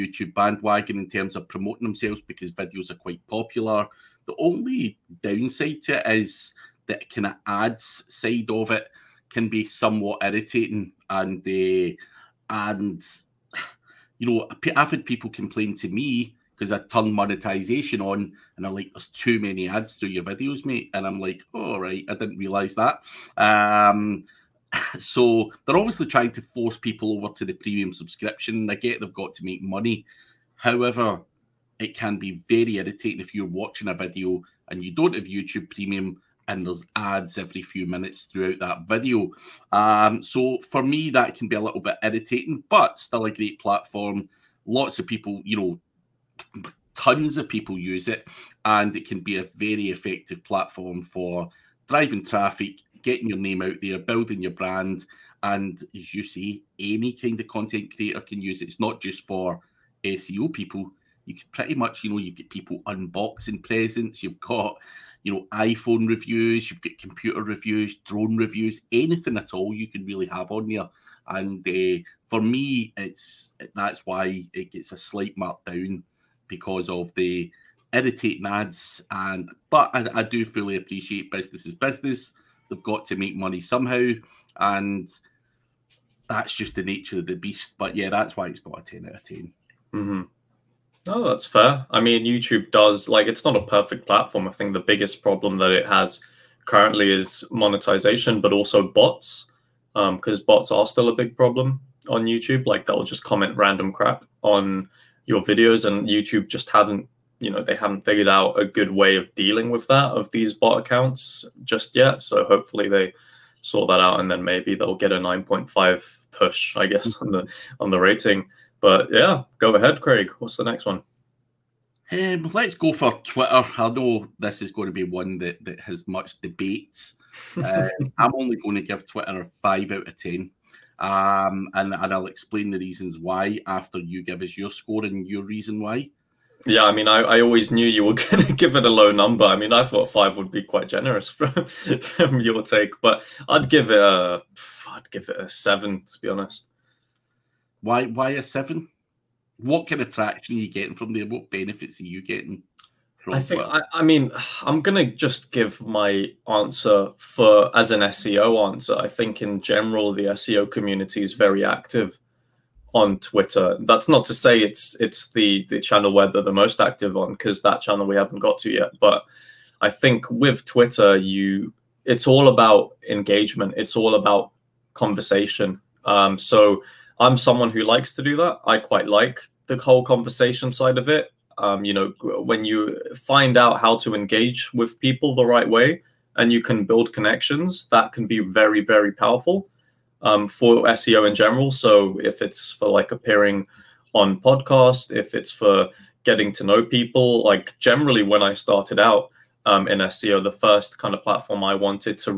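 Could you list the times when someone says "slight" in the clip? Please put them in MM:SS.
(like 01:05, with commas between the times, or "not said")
01:14.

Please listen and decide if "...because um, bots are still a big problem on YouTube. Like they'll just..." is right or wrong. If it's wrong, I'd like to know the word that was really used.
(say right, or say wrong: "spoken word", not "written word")
right.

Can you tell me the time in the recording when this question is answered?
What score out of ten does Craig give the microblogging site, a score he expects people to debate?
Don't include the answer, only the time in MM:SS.
02:09.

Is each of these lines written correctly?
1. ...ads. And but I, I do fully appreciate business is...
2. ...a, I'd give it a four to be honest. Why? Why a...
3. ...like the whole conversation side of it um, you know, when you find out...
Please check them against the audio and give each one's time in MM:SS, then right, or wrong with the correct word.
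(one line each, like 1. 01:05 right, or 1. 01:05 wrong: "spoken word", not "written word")
1. 01:18 right
2. 02:23 wrong: "seven", not "four"
3. 02:59 right.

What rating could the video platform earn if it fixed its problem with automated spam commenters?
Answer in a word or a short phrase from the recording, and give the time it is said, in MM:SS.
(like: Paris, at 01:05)
9.5, at 01:55.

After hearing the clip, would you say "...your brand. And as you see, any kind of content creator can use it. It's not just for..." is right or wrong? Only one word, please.
right.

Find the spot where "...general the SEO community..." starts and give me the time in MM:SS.
02:39.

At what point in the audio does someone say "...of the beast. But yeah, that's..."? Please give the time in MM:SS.
01:27.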